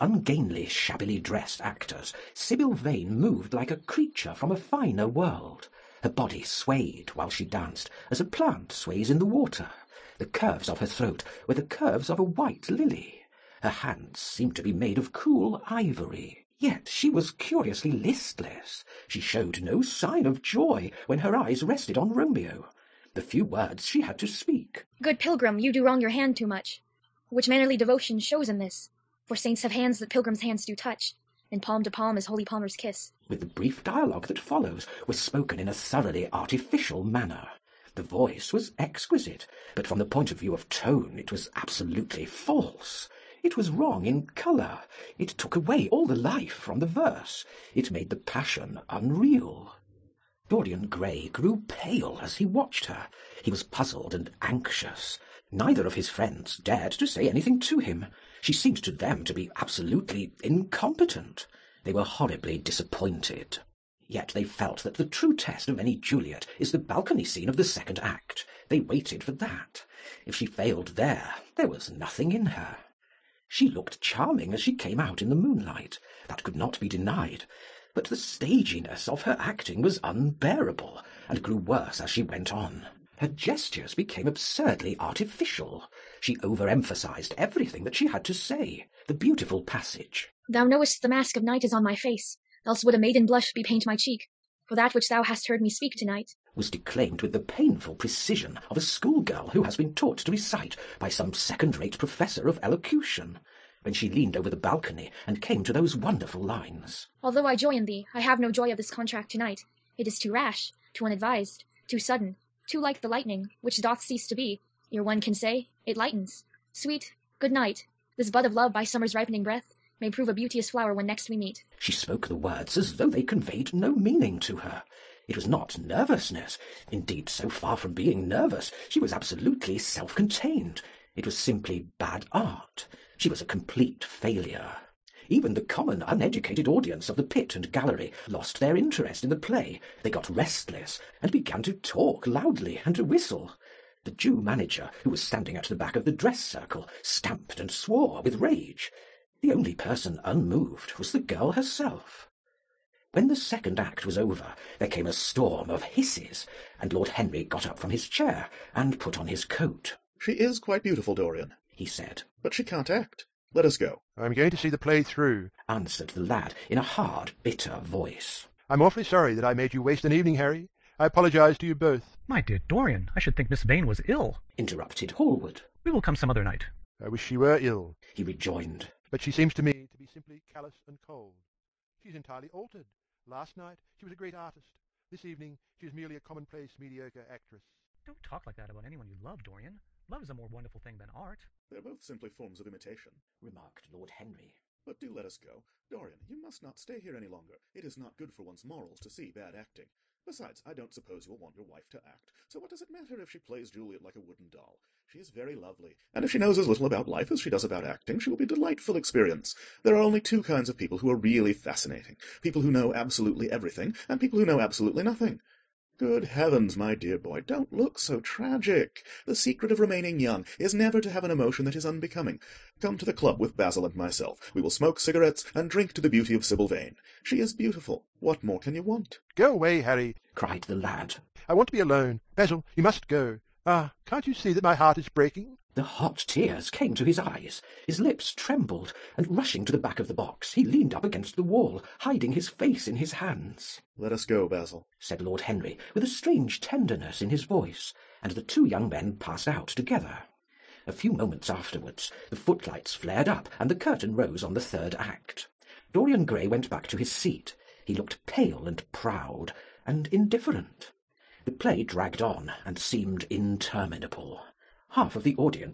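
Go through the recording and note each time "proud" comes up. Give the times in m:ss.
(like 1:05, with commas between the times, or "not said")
4:18.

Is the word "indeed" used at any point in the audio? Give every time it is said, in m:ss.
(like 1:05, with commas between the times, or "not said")
2:06.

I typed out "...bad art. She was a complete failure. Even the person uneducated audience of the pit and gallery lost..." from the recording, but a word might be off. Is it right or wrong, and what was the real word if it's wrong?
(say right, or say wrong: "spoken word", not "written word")
wrong: "common", not "person".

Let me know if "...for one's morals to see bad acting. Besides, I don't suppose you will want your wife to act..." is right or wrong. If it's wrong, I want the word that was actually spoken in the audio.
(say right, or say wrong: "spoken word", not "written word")
right.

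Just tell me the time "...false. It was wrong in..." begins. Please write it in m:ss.
0:42.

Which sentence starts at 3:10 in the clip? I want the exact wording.
Love is a more wonderful thing than art." "They're both simply forms of imitation," remarked Lord Henry.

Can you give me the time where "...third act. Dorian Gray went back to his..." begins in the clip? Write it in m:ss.
4:14.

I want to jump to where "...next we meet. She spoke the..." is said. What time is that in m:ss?
2:01.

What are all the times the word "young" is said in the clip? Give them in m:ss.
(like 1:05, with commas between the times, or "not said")
3:40, 4:08.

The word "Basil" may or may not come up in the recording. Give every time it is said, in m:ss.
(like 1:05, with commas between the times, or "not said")
3:43, 3:52, 4:04.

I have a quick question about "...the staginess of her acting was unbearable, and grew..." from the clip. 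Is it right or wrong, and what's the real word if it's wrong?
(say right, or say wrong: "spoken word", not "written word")
right.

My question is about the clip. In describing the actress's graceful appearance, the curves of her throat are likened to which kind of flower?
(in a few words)
White lily.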